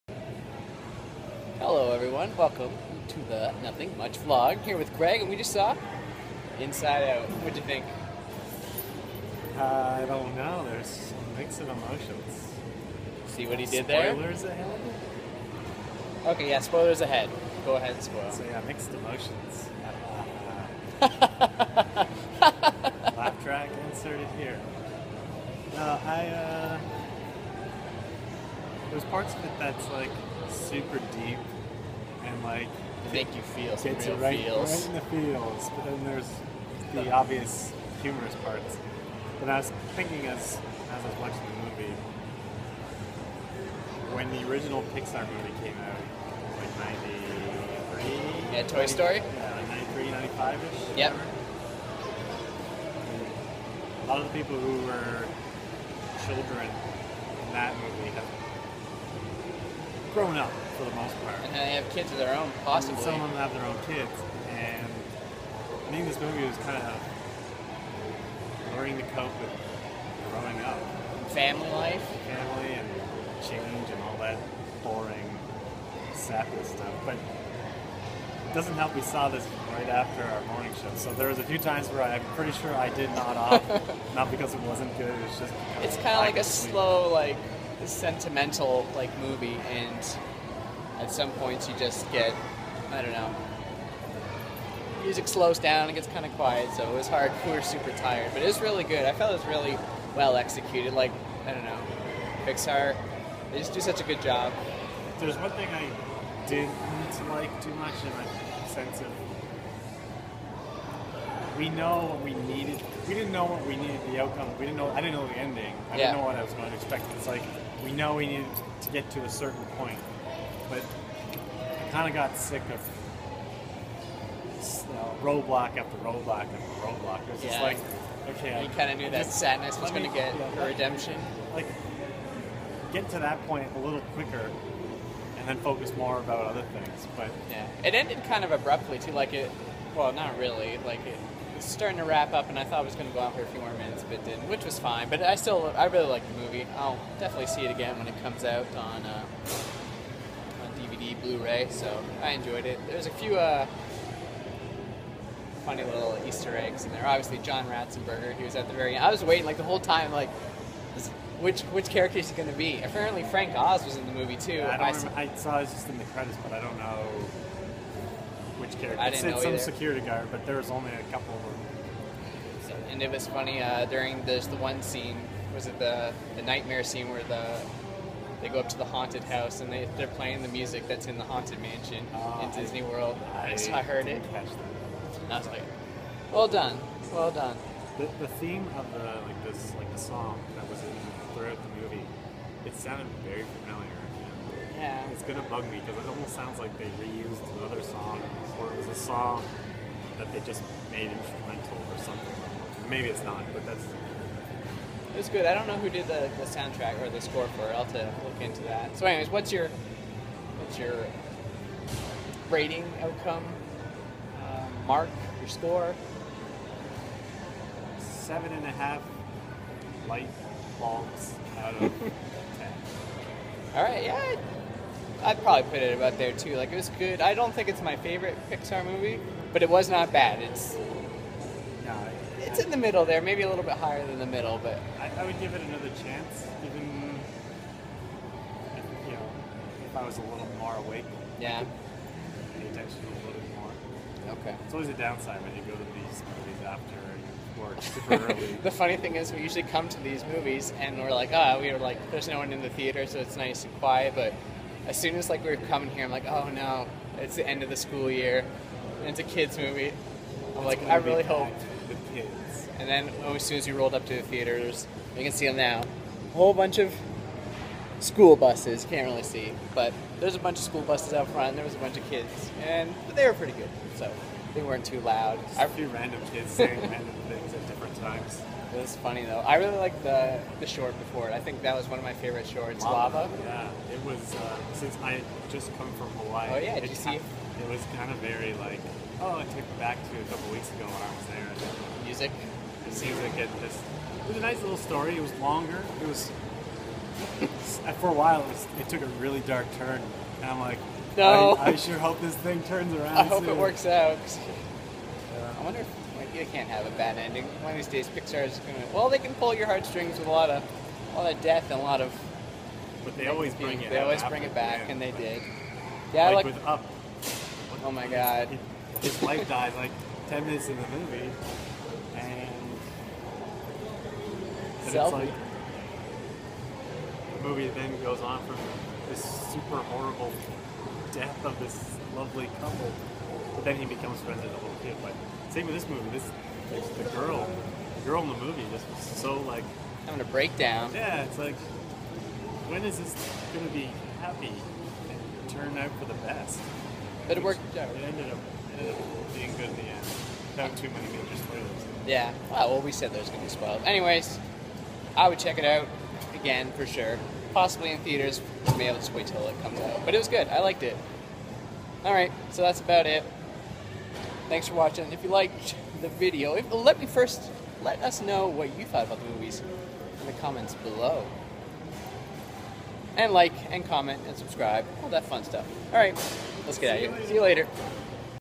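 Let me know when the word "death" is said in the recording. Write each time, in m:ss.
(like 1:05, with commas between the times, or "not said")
5:11, 5:31.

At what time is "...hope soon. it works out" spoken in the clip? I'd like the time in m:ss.
5:03.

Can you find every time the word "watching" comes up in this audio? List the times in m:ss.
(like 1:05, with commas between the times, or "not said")
0:41, 6:04.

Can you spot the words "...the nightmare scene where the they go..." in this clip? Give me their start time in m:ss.
2:56.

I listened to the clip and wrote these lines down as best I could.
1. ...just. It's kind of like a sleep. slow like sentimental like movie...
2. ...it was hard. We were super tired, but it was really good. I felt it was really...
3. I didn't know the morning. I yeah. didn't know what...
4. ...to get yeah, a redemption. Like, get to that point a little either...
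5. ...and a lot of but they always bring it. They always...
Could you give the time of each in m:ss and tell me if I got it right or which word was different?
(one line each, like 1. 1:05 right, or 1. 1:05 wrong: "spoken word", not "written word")
1. 1:25 right
2. 1:36 right
3. 1:54 wrong: "ending", not "morning"
4. 2:10 wrong: "quicker", not "either"
5. 5:11 right.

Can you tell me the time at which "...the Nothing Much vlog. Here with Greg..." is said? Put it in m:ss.
0:03.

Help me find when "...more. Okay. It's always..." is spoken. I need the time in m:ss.
4:03.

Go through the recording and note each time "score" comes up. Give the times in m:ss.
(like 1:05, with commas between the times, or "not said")
3:27, 3:35.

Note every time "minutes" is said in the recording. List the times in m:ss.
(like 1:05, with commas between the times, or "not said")
2:23, 5:20.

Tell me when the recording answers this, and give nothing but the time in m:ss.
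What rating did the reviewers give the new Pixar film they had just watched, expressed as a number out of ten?
3:37.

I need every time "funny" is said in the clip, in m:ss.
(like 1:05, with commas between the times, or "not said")
2:35, 2:53, 4:08, 4:38.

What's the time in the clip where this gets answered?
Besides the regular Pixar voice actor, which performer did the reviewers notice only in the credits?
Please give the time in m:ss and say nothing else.
2:43.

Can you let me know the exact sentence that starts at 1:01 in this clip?
And they have kids of their own, possibly.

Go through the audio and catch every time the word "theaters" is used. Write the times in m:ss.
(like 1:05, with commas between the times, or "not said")
4:12, 4:24, 5:57.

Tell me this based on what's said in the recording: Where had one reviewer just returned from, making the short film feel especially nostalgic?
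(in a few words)
Hawaii.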